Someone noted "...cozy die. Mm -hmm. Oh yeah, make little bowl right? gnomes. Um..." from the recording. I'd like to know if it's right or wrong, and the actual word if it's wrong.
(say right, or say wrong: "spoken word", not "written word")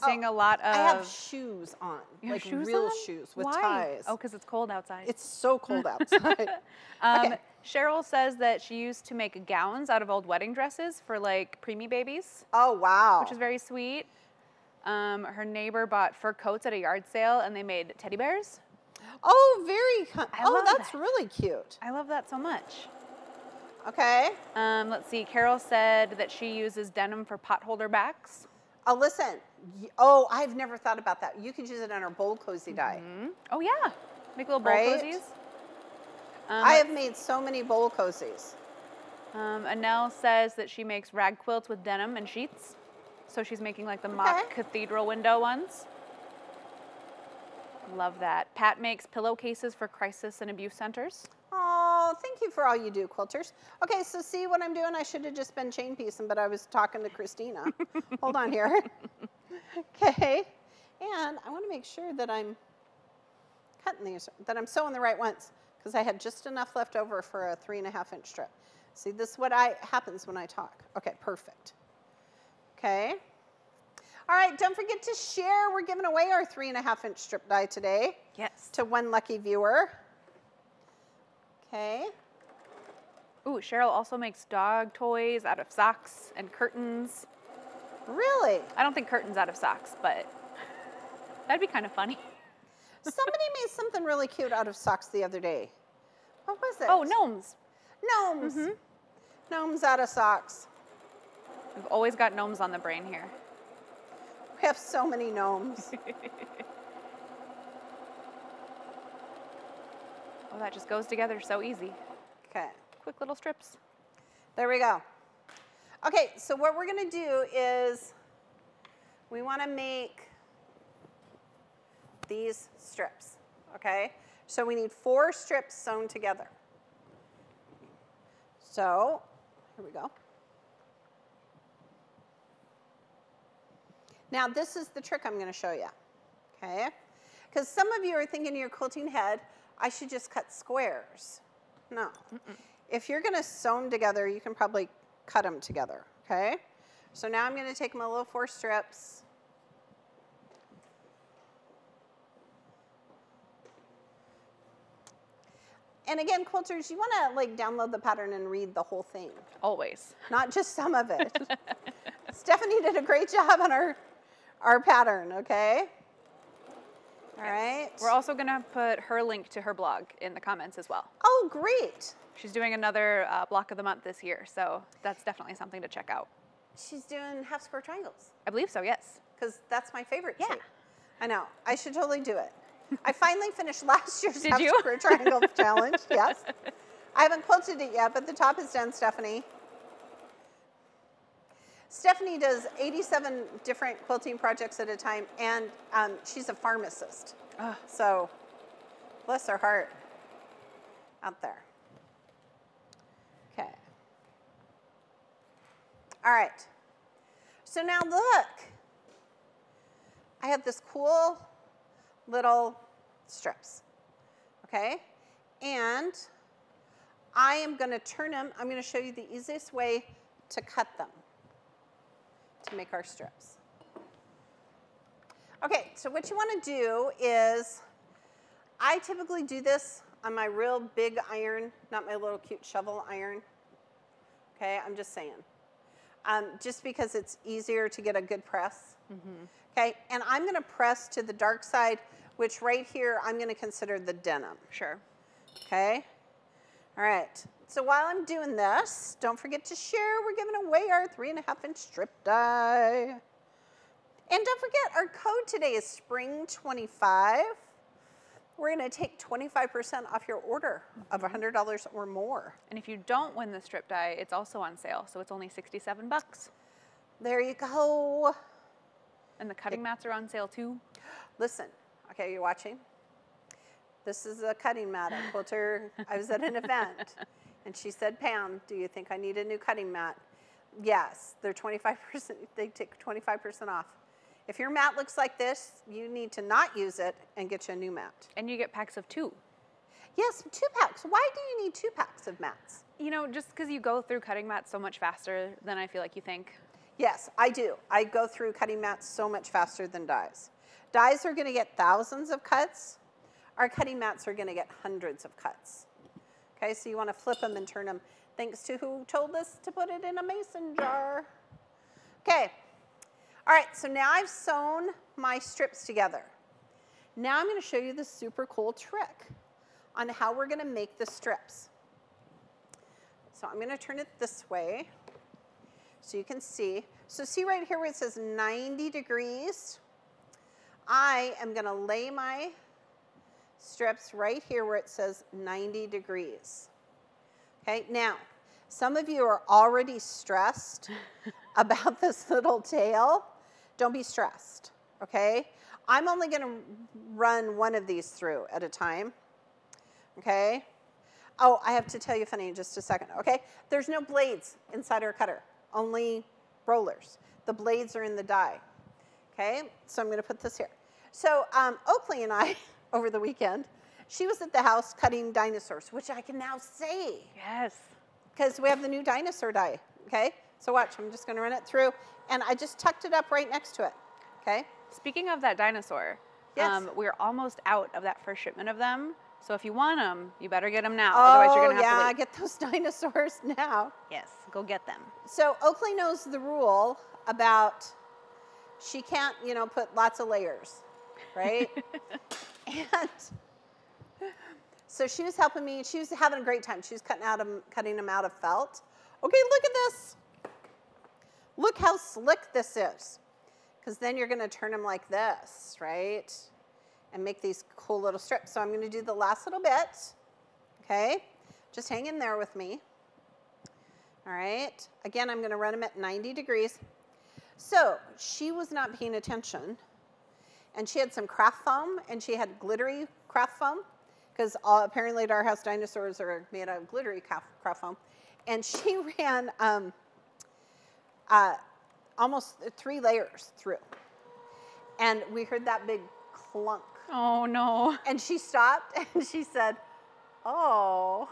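wrong: "cozies", not "gnomes".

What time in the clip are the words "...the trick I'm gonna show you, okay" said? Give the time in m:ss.
2:14.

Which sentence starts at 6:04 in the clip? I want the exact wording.
She was at the house cutting dinosaurs, which I can now say.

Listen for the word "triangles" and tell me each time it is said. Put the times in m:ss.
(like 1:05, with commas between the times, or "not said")
2:57, 3:04.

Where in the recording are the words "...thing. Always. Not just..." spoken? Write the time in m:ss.
2:39.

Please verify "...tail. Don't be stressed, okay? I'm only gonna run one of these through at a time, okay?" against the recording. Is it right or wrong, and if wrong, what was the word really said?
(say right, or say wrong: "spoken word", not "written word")
right.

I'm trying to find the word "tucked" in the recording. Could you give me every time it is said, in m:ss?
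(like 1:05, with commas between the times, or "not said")
6:12.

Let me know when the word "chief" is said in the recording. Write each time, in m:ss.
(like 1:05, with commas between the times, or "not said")
not said.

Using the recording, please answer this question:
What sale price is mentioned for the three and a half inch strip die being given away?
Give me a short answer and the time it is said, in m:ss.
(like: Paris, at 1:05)
$67, at 4:25.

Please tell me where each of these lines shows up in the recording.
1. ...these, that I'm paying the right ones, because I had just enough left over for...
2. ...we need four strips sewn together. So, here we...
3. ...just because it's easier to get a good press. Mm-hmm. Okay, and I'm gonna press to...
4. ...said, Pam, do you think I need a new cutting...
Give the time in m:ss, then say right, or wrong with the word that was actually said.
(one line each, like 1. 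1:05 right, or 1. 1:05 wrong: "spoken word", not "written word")
1. 1:04 wrong: "sewing", not "paying"
2. 2:04 right
3. 3:56 right
4. 4:37 right.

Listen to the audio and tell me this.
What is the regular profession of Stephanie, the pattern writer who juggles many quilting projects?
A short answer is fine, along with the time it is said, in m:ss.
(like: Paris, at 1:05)
pharmacist, at 3:16.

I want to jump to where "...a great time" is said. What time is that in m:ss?
6:36.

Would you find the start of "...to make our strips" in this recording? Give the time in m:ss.
3:42.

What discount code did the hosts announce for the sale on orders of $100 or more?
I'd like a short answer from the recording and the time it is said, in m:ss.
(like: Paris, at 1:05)
SPRING25, at 4:15.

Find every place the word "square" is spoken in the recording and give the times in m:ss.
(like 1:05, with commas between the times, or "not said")
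2:20, 2:57, 3:04.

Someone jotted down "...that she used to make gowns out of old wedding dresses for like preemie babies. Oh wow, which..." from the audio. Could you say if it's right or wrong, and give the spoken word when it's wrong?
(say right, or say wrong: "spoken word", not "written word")
right.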